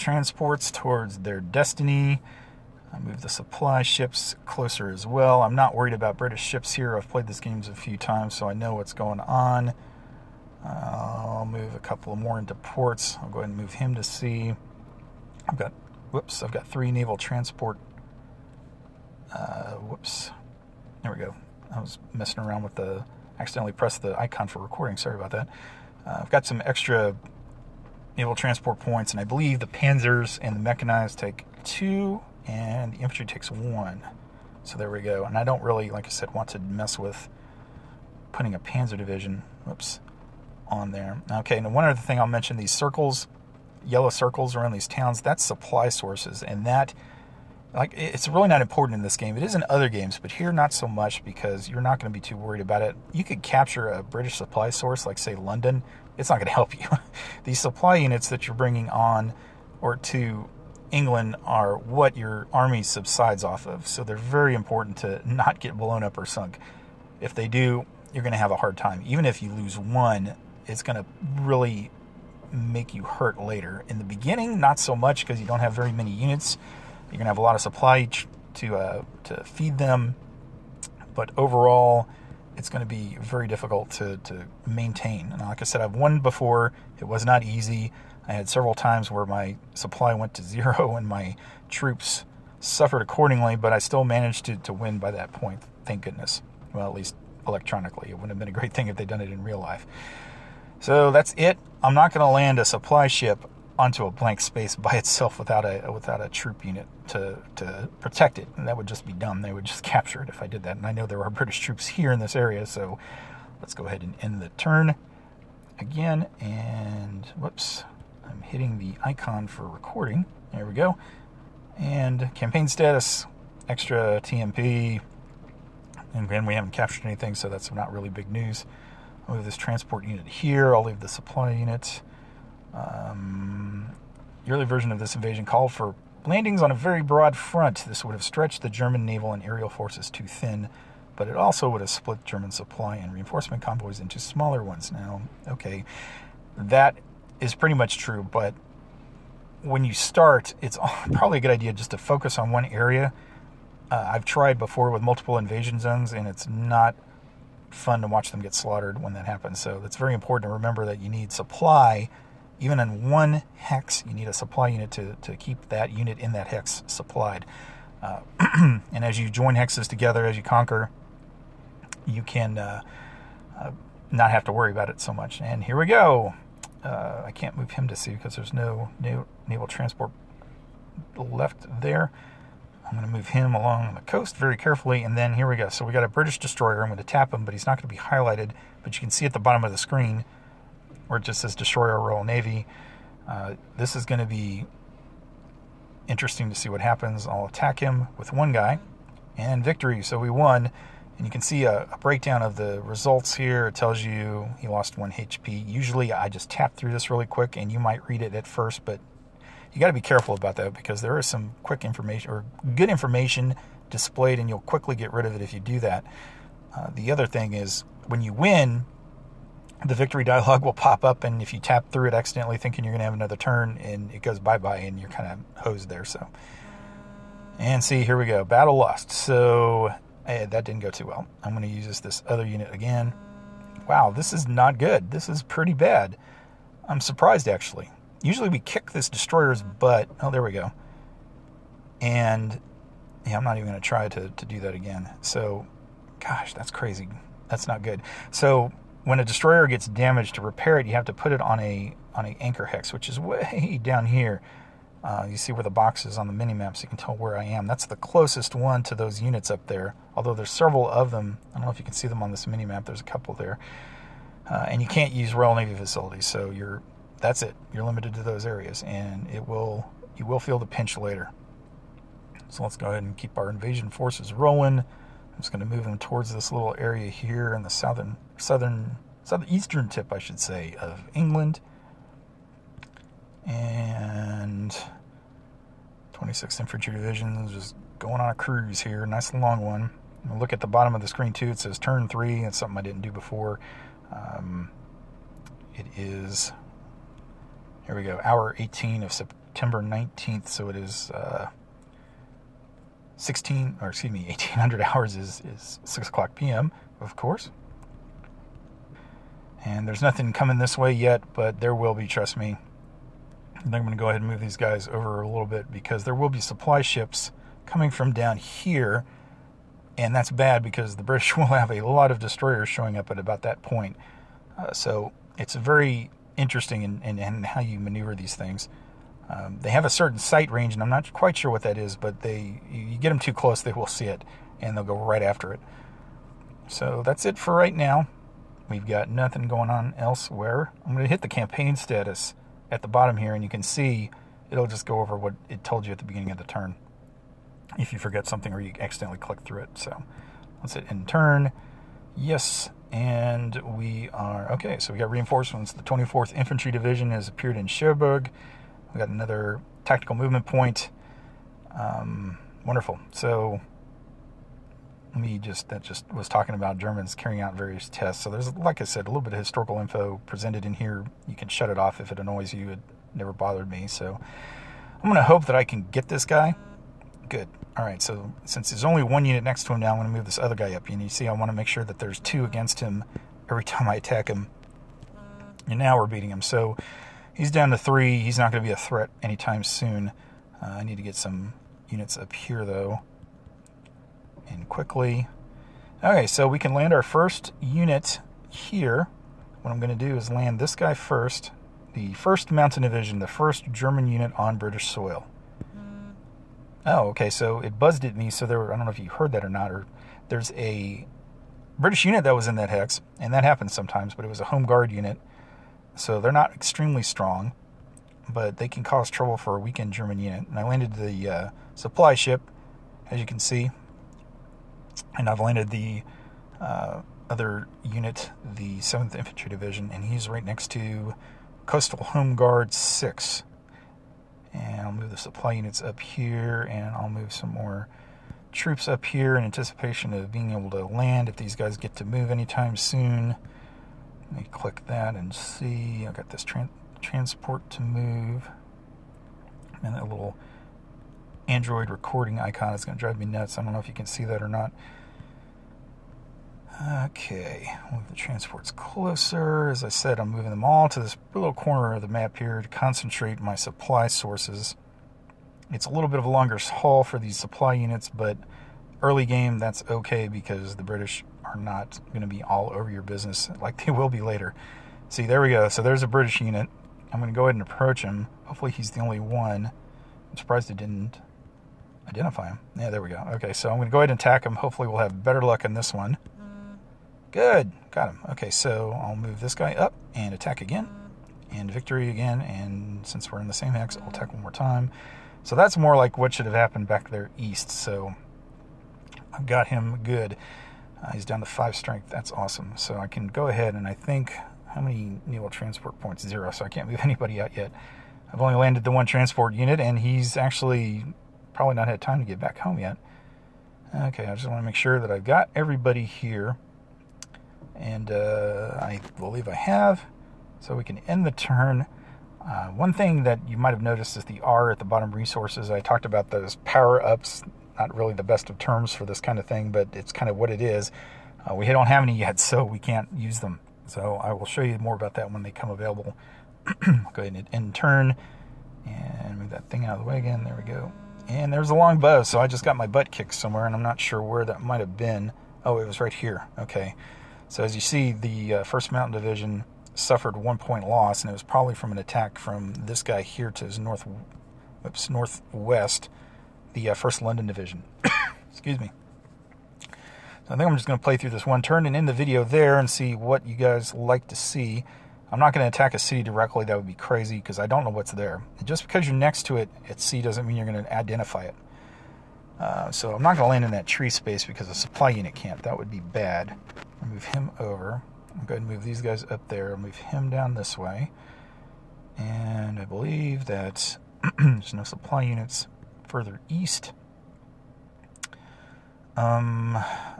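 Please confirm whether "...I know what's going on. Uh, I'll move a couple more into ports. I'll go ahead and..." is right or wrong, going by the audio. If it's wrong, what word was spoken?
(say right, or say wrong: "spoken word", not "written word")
right.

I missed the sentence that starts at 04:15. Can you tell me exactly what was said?
Uh, you see where the box is on the mini map, so you can tell where I am.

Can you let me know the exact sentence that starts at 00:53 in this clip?
You could capture a British supply source like say London.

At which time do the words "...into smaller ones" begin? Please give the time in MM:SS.
02:23.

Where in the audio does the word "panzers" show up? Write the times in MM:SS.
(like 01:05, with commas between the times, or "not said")
00:29, 00:38.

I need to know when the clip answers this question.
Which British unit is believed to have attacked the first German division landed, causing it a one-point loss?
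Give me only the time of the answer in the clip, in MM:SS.
09:16.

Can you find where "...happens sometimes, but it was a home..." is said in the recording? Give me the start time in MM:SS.
06:53.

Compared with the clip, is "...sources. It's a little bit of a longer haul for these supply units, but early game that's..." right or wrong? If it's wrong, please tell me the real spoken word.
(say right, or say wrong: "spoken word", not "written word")
right.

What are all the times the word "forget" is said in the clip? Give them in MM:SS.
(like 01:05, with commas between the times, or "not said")
05:47.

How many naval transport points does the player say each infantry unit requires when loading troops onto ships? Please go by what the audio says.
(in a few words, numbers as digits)
1.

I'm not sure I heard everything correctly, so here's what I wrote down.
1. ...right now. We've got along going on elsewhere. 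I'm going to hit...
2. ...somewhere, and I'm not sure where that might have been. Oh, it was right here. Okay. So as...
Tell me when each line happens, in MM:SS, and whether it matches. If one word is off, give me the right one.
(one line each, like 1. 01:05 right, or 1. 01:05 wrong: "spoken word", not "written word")
1. 05:37 wrong: "nothing", not "along"
2. 09:03 right.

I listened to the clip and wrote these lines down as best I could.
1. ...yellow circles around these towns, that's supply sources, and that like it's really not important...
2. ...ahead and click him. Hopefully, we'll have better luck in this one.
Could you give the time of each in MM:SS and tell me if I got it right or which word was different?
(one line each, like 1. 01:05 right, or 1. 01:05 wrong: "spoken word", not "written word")
1. 00:43 right
2. 08:03 wrong: "attack", not "click".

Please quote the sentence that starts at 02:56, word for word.
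Uh, I can't move him to sea because there's no, no naval transport left there.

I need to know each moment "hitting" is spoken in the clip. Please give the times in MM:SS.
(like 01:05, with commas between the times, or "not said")
01:58.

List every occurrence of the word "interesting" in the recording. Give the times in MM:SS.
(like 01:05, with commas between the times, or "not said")
03:16, 05:26.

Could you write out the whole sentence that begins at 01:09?
Even if you lose one, it's going to really make you hurt later.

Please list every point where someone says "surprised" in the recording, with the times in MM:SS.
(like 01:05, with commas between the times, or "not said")
03:56, 08:00.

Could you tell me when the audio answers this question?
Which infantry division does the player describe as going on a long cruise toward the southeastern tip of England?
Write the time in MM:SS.
04:46.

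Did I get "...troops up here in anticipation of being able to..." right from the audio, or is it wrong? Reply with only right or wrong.
right.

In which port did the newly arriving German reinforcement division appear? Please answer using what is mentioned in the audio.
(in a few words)
Cherbourg.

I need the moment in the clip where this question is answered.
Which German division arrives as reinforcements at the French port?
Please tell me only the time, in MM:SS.
05:55.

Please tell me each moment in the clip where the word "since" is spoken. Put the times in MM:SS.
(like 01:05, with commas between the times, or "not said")
06:18, 08:13.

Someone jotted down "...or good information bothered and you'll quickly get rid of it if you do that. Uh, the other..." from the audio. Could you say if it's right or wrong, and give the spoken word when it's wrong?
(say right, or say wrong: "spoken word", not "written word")
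wrong: "displayed", not "bothered".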